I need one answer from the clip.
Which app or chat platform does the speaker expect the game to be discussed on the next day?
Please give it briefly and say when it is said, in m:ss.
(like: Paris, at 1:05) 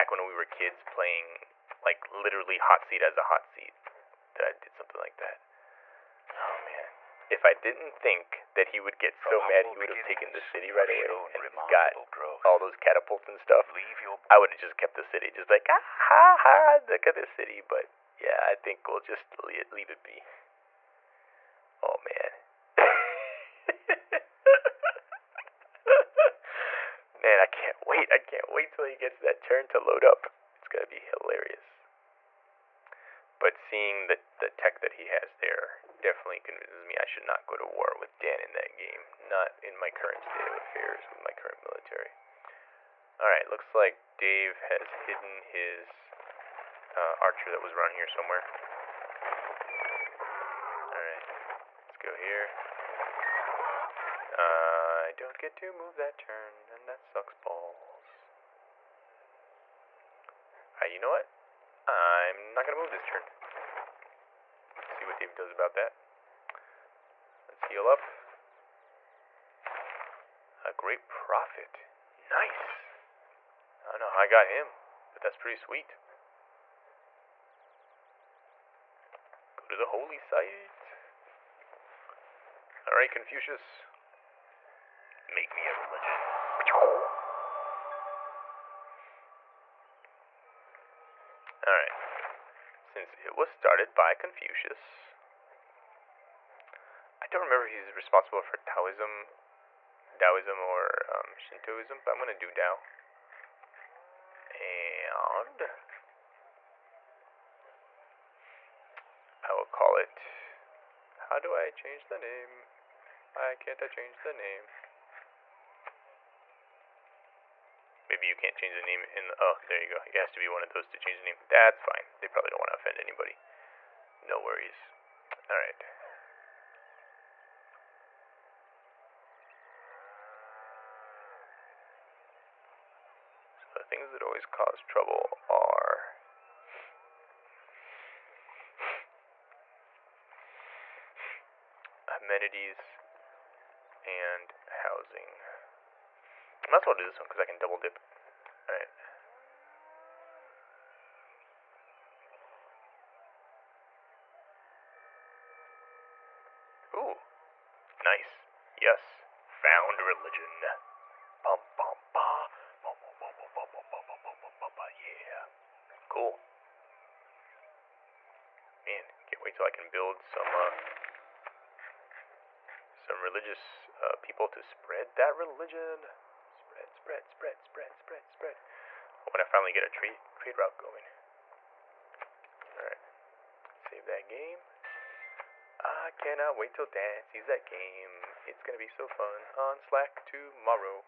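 Slack, at 3:09.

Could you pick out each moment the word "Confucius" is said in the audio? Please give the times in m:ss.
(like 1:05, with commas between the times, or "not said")
1:23, 1:34.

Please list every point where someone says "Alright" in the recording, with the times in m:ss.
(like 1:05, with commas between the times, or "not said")
0:43, 0:50, 1:00, 1:22, 1:31, 2:28.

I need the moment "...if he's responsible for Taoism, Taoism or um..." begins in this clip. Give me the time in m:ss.
1:37.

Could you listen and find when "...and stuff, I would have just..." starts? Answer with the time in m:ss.
0:13.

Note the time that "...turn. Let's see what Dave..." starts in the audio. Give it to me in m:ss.
1:03.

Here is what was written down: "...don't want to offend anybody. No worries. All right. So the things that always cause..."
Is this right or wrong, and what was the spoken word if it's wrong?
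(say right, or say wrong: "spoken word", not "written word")
right.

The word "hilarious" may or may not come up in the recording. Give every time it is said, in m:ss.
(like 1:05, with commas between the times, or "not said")
0:30.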